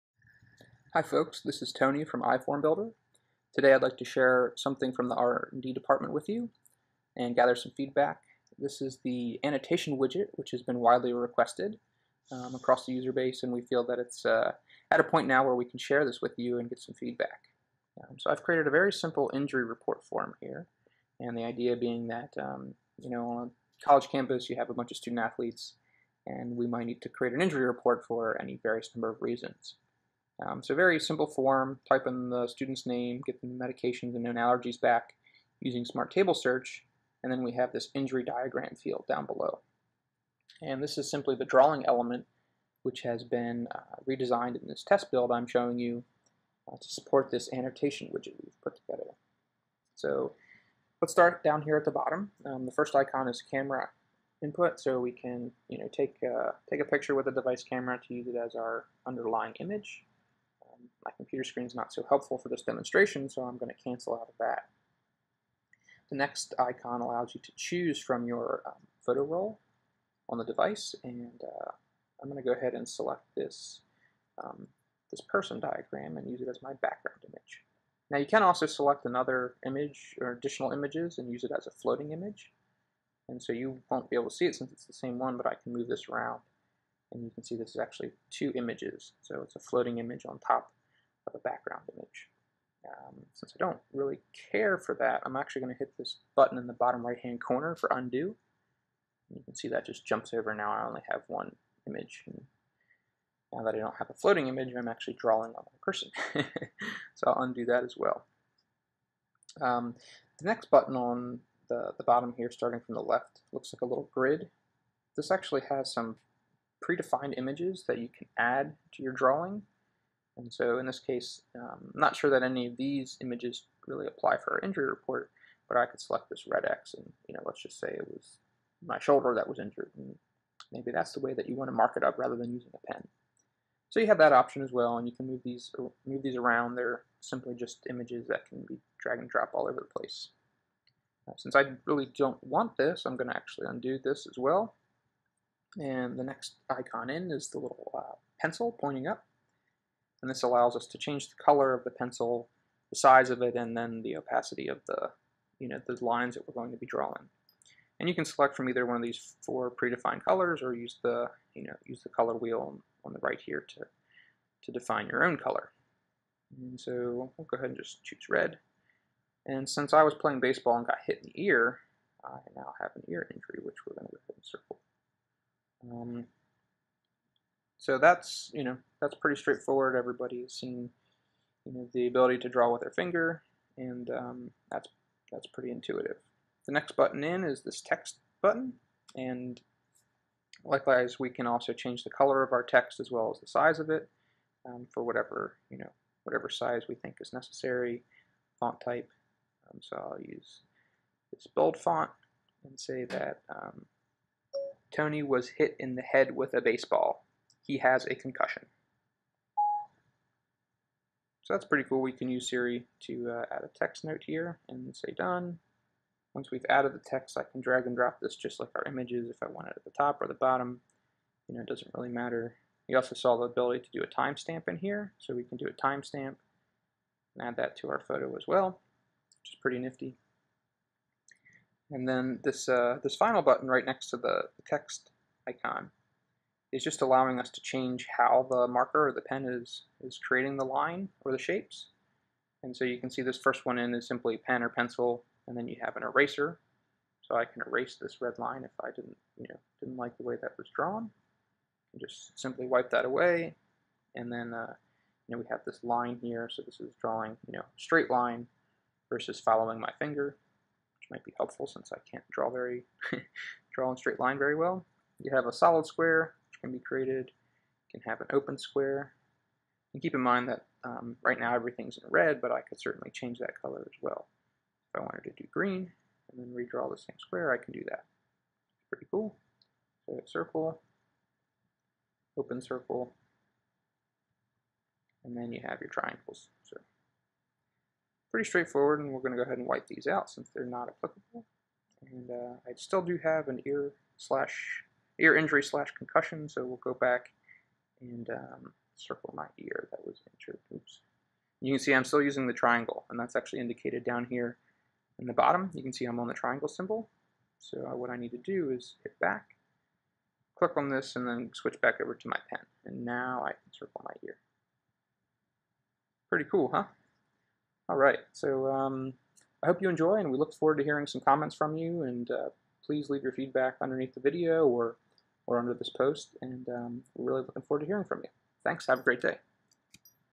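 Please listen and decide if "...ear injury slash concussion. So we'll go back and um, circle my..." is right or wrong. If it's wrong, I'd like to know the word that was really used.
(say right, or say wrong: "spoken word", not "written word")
right.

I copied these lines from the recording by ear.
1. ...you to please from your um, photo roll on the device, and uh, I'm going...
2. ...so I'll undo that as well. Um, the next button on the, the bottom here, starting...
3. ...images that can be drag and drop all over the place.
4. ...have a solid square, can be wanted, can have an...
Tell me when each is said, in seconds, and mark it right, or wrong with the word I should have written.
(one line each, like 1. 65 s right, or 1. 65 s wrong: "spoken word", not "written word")
1. 67 s wrong: "choose", not "please"
2. 107 s right
3. 137 s right
4. 265 s wrong: "created", not "wanted".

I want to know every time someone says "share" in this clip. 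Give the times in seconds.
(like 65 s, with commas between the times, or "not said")
4 s, 15 s.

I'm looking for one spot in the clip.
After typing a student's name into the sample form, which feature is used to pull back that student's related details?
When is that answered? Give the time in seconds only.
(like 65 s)
35 s.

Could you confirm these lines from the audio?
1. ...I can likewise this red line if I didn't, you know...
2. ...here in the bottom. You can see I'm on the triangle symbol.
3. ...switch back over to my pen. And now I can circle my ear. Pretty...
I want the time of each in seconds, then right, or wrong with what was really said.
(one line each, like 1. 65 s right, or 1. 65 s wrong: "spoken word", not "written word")
1. 247 s wrong: "erase", not "likewise"
2. 304 s right
3. 311 s right.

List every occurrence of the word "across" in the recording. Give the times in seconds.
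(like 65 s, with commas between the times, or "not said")
12 s.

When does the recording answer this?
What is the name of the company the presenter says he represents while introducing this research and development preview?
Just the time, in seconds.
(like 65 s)
2 s.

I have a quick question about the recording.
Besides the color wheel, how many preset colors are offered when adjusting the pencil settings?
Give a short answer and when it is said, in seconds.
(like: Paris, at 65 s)
4, at 159 s.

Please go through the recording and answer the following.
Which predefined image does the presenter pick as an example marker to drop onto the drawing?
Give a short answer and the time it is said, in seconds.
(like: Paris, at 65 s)
red X, at 126 s.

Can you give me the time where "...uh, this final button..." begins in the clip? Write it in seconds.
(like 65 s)
232 s.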